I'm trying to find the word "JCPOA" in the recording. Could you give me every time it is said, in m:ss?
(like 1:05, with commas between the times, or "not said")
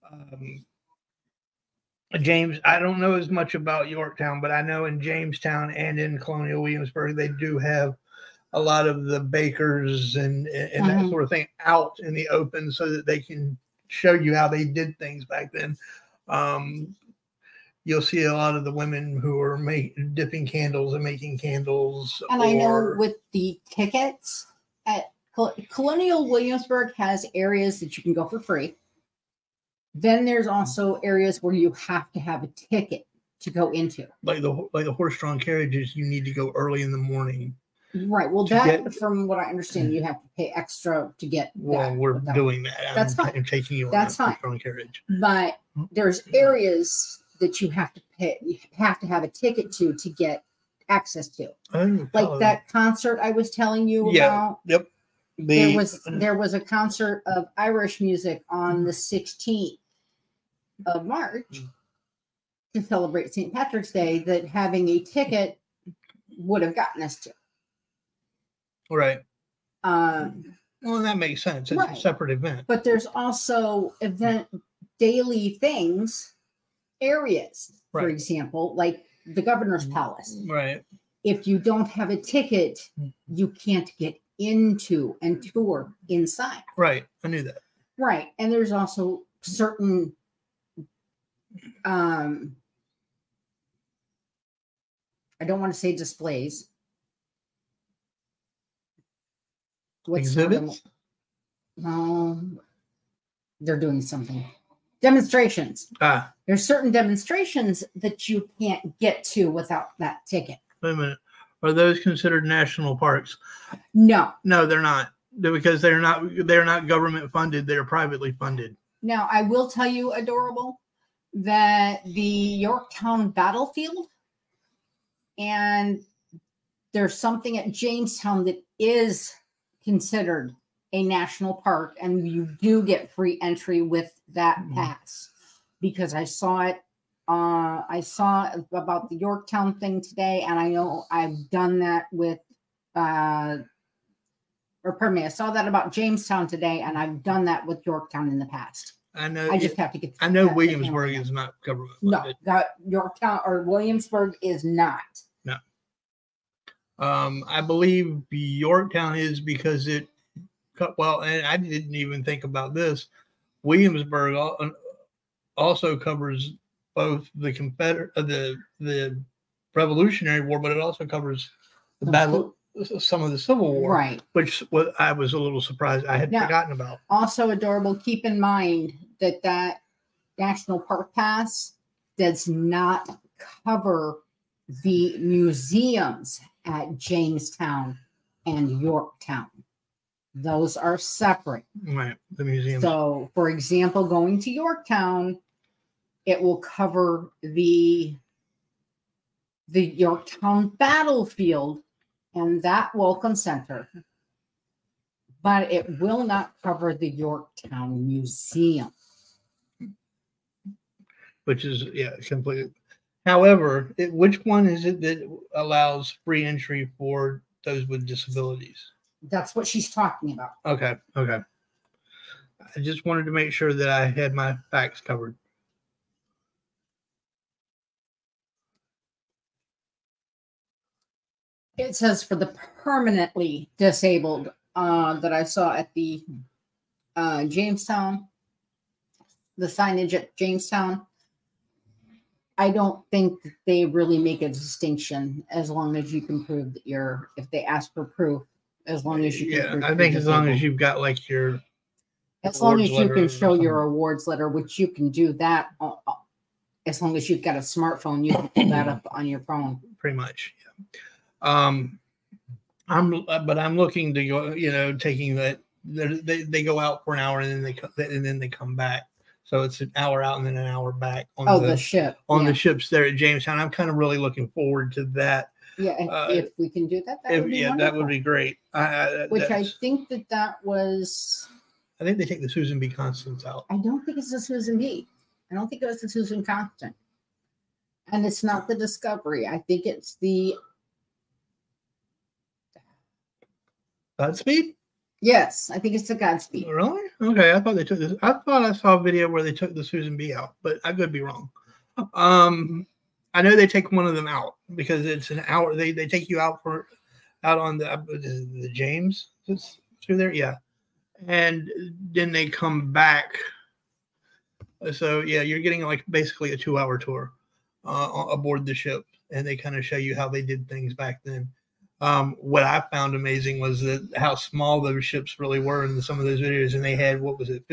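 not said.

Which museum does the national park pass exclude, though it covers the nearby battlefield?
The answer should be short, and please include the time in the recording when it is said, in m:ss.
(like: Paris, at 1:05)
Yorktown Museum, at 3:27.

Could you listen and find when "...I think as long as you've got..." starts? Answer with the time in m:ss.
4:09.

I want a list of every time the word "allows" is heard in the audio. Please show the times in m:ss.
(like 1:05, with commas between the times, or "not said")
3:35.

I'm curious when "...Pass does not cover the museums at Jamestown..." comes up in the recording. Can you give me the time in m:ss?
3:01.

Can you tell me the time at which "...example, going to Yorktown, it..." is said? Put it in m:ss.
3:13.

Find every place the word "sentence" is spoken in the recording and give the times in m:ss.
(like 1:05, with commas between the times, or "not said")
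not said.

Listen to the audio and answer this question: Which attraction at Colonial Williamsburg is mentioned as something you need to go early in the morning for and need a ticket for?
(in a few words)
horse-drawn carriages.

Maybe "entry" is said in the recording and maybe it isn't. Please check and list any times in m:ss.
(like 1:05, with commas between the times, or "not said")
2:13, 3:36.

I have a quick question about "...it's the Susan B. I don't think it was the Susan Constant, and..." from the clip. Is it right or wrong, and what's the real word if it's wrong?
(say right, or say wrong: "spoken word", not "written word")
right.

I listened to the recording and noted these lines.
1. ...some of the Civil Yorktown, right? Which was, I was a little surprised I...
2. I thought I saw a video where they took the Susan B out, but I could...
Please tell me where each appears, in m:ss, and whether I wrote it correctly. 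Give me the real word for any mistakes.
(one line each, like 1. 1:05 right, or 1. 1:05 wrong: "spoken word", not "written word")
1. 2:52 wrong: "War", not "Yorktown"
2. 4:58 right.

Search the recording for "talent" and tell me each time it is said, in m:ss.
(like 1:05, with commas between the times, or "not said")
not said.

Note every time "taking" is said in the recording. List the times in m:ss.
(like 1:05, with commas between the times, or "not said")
0:43, 4:24.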